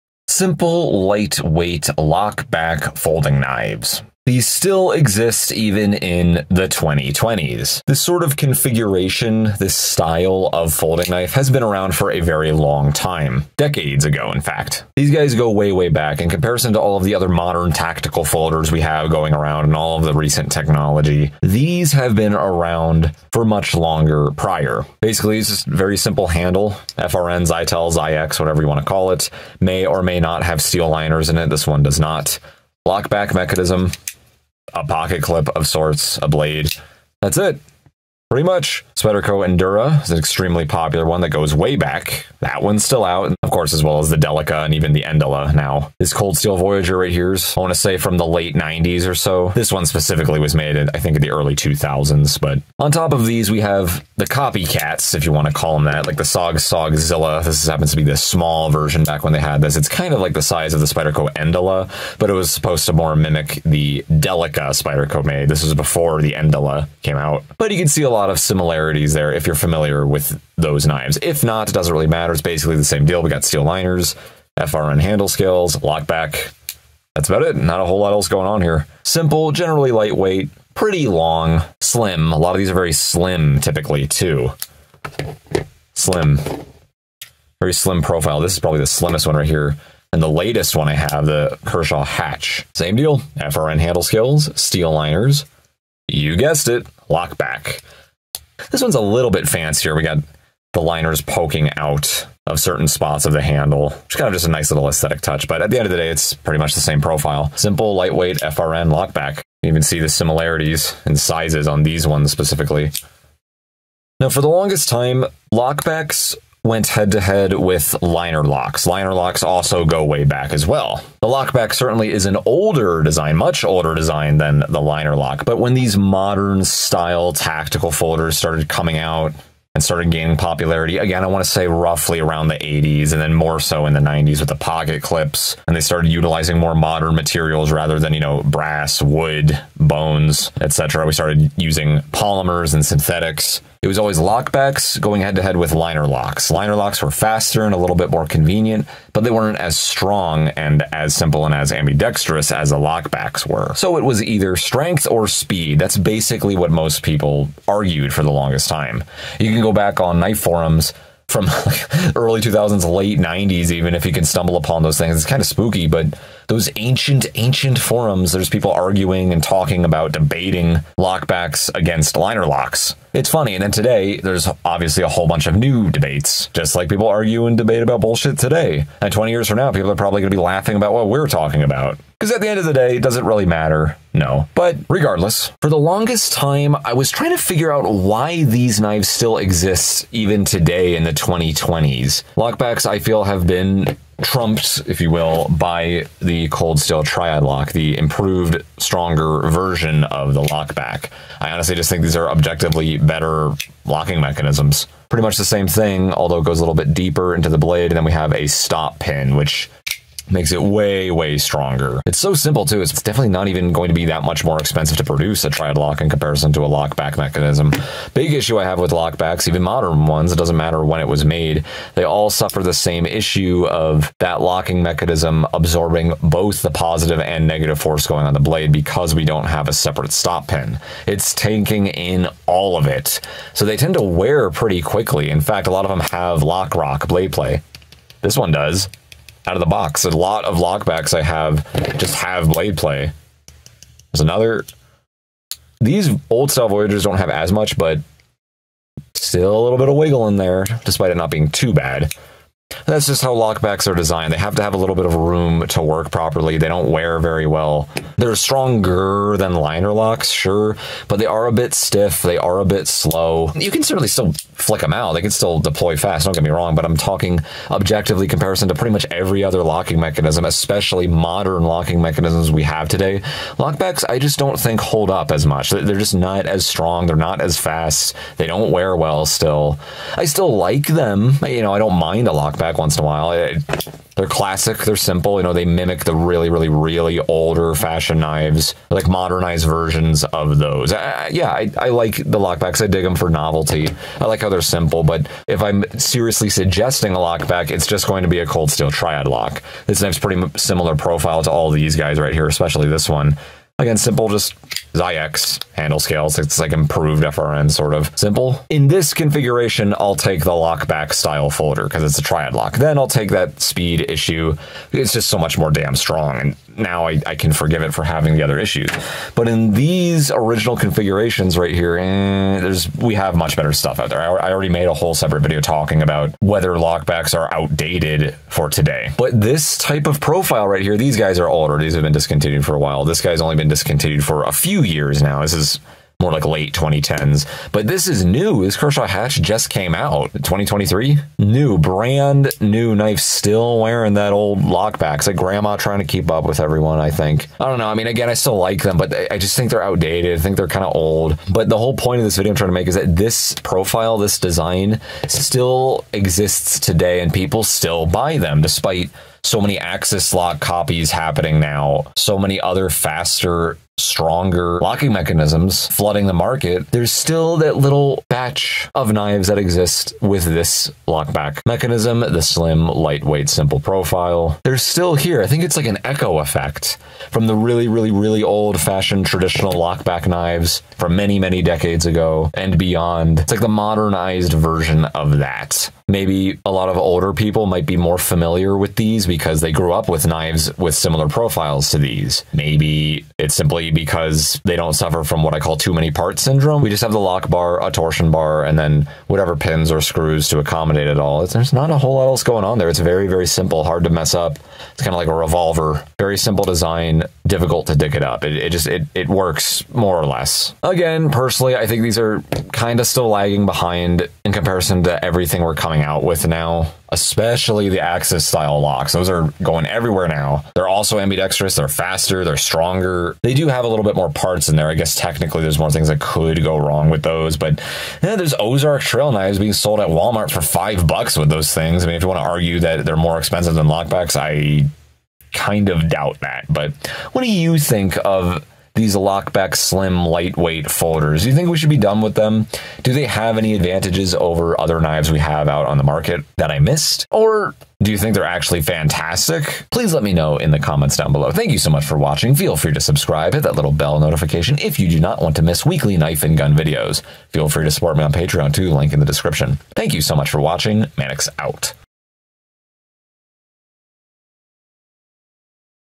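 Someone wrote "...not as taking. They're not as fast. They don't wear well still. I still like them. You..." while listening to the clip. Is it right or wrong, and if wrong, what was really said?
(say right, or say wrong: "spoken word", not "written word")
wrong: "strong", not "taking".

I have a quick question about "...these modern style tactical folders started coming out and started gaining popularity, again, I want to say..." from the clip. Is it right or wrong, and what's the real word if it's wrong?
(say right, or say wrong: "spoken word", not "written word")
right.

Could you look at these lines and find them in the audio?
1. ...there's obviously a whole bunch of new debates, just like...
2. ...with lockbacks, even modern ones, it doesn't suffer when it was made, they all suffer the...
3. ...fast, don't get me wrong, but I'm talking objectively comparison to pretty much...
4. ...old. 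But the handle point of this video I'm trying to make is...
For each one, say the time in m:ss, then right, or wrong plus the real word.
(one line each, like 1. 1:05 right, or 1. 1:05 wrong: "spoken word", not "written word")
1. 2:54 right
2. 3:38 wrong: "matter", not "suffer"
3. 4:25 right
4. 5:50 wrong: "whole", not "handle".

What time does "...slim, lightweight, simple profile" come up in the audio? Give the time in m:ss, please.
6:12.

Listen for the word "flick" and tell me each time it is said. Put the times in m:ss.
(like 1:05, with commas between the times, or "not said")
4:24.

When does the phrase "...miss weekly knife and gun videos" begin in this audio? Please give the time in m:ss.
7:35.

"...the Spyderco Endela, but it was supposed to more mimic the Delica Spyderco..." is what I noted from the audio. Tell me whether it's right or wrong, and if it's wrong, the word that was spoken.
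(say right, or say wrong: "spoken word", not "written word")
right.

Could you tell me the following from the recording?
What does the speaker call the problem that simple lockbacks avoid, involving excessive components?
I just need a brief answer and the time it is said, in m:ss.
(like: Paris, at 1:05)
too many parts syndrome, at 6:35.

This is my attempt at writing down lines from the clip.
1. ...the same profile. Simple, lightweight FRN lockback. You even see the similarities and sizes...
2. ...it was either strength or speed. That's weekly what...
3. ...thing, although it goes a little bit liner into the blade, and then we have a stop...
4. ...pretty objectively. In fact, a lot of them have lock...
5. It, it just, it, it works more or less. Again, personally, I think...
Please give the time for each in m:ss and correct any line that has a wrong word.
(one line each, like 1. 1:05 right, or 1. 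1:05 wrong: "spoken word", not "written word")
1. 1:46 right
2. 2:33 wrong: "basically", not "weekly"
3. 3:25 wrong: "deeper", not "liner"
4. 3:54 wrong: "quickly", not "objectively"
5. 6:48 right.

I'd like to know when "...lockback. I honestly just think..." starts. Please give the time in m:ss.
3:20.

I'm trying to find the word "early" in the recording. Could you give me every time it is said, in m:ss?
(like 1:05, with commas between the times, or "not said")
0:51, 2:42.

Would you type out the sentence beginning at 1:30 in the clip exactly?
And the latest one I have, the Kershaw Hatch.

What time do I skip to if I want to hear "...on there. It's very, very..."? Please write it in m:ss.
6:42.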